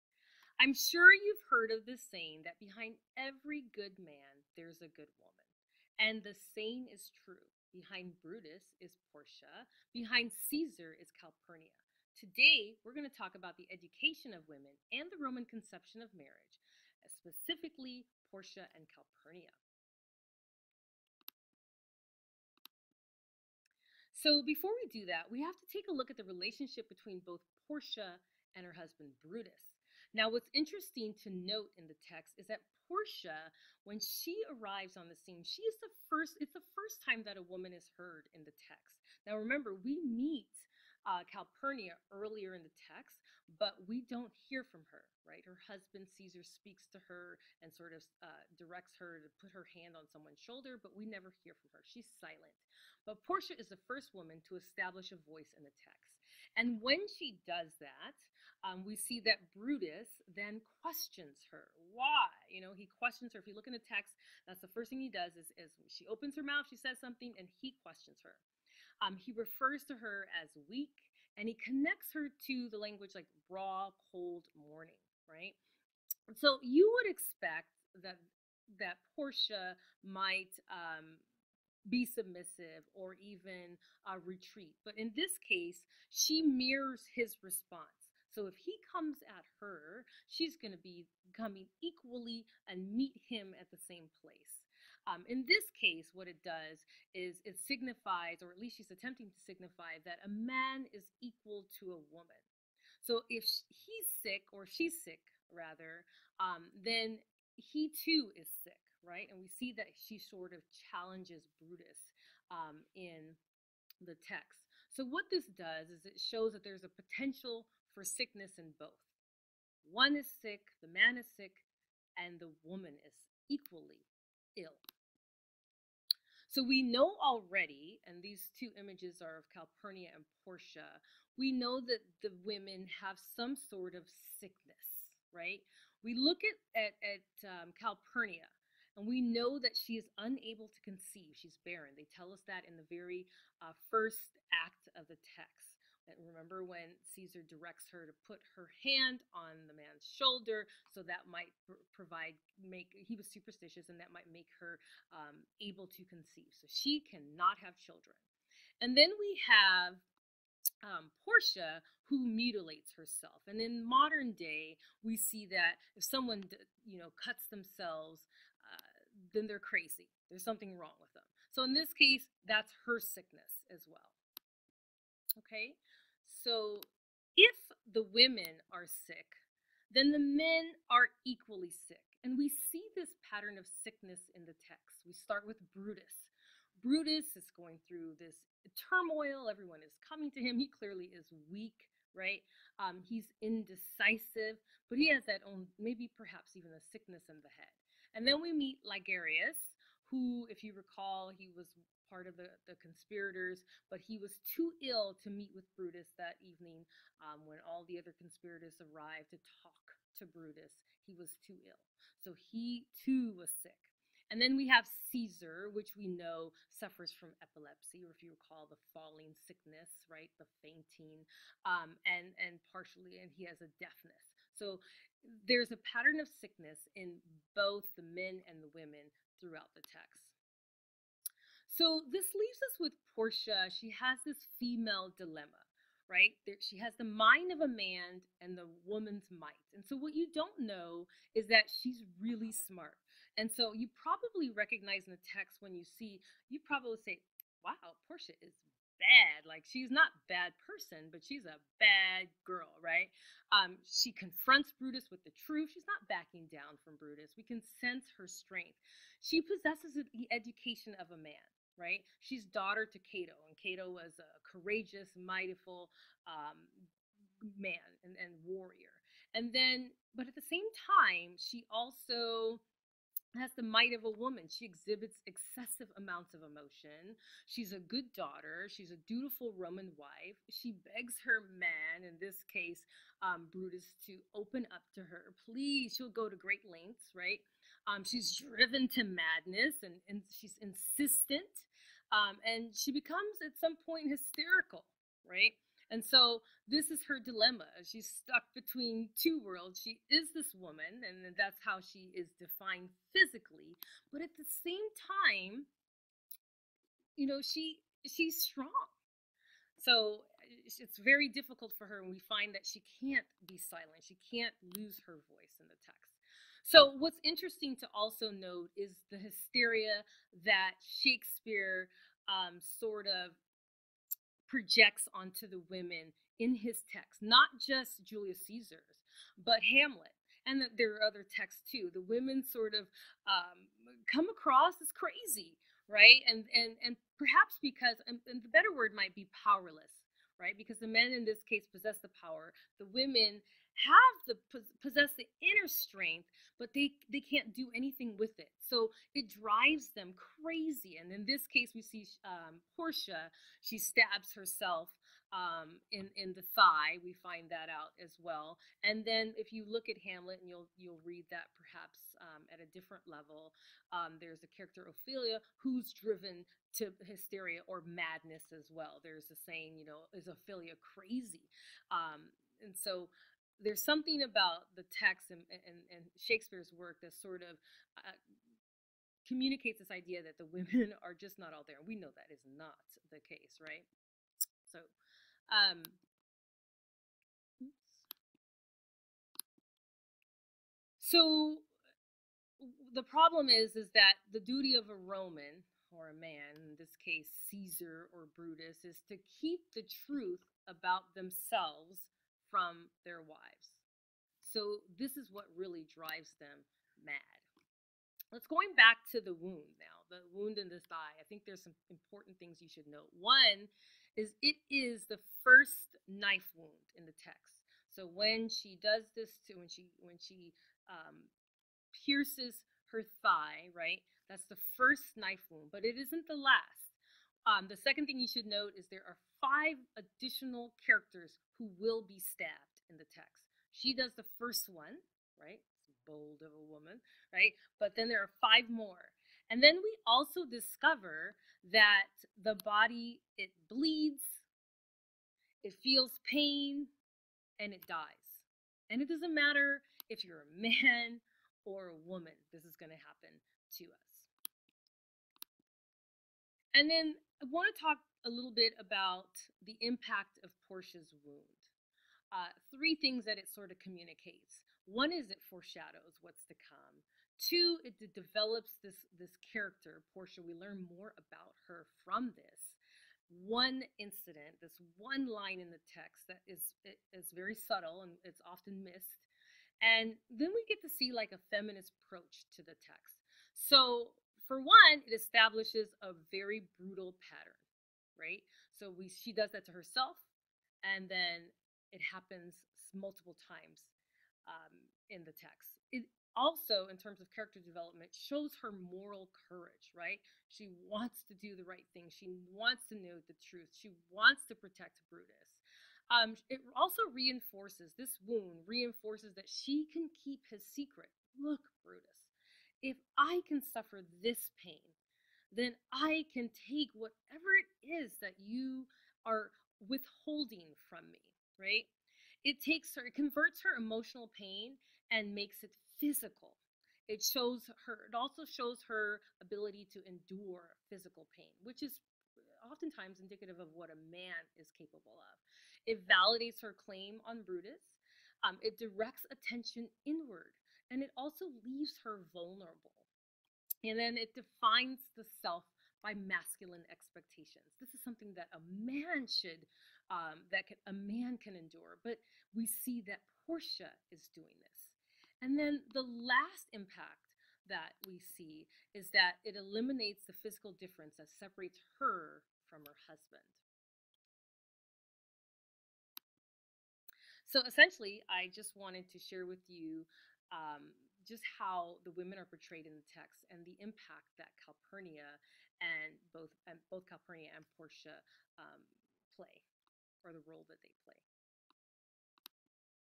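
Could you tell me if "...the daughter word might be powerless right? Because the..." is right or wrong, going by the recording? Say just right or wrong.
wrong.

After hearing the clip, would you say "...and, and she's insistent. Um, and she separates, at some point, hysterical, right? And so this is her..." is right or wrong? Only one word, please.
wrong.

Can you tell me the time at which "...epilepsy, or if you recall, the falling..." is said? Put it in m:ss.
3:37.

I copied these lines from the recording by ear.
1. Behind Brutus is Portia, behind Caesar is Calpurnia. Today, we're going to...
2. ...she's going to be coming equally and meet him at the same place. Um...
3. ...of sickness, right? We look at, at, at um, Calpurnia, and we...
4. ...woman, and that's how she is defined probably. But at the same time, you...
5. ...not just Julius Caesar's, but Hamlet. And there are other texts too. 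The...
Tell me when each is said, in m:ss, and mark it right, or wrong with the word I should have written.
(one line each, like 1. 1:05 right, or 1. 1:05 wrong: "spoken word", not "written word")
1. 0:07 right
2. 1:30 right
3. 2:13 right
4. 5:00 wrong: "physically", not "probably"
5. 5:27 right.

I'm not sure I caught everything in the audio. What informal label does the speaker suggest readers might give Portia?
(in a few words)
bad girl.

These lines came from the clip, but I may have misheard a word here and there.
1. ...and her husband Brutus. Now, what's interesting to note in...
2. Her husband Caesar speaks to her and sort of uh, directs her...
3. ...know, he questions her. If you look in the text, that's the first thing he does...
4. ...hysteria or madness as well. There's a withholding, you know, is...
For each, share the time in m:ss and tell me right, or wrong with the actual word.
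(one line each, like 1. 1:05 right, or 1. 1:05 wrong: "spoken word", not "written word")
1. 0:28 right
2. 0:45 right
3. 1:02 right
4. 6:07 wrong: "saying", not "withholding".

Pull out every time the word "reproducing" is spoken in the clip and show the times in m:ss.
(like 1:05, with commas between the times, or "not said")
not said.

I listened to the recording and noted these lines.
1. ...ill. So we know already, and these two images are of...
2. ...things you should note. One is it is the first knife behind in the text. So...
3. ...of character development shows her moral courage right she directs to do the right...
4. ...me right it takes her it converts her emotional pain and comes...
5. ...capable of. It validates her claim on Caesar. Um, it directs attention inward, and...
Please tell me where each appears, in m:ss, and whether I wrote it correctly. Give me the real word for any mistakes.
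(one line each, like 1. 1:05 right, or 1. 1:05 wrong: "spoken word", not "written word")
1. 2:04 right
2. 6:52 wrong: "wound", not "behind"
3. 8:17 wrong: "wants", not "directs"
4. 8:41 wrong: "makes", not "comes"
5. 8:54 wrong: "Brutus", not "Caesar".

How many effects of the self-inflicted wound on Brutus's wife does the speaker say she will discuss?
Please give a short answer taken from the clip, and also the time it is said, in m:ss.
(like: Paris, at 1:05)
3, at 7:42.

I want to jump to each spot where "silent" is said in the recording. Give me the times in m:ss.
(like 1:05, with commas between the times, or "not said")
0:52, 5:13.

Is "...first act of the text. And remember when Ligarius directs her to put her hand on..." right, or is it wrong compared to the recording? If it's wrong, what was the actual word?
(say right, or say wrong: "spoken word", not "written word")
wrong: "Caesar", not "Ligarius".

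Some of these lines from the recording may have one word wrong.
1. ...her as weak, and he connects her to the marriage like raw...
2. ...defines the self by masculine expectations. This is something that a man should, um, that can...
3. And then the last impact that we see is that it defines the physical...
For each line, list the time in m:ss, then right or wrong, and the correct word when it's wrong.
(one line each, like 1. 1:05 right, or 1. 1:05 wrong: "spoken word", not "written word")
1. 1:09 wrong: "language", not "marriage"
2. 9:04 right
3. 9:15 wrong: "eliminates", not "defines".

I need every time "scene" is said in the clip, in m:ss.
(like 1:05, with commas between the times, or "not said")
0:35.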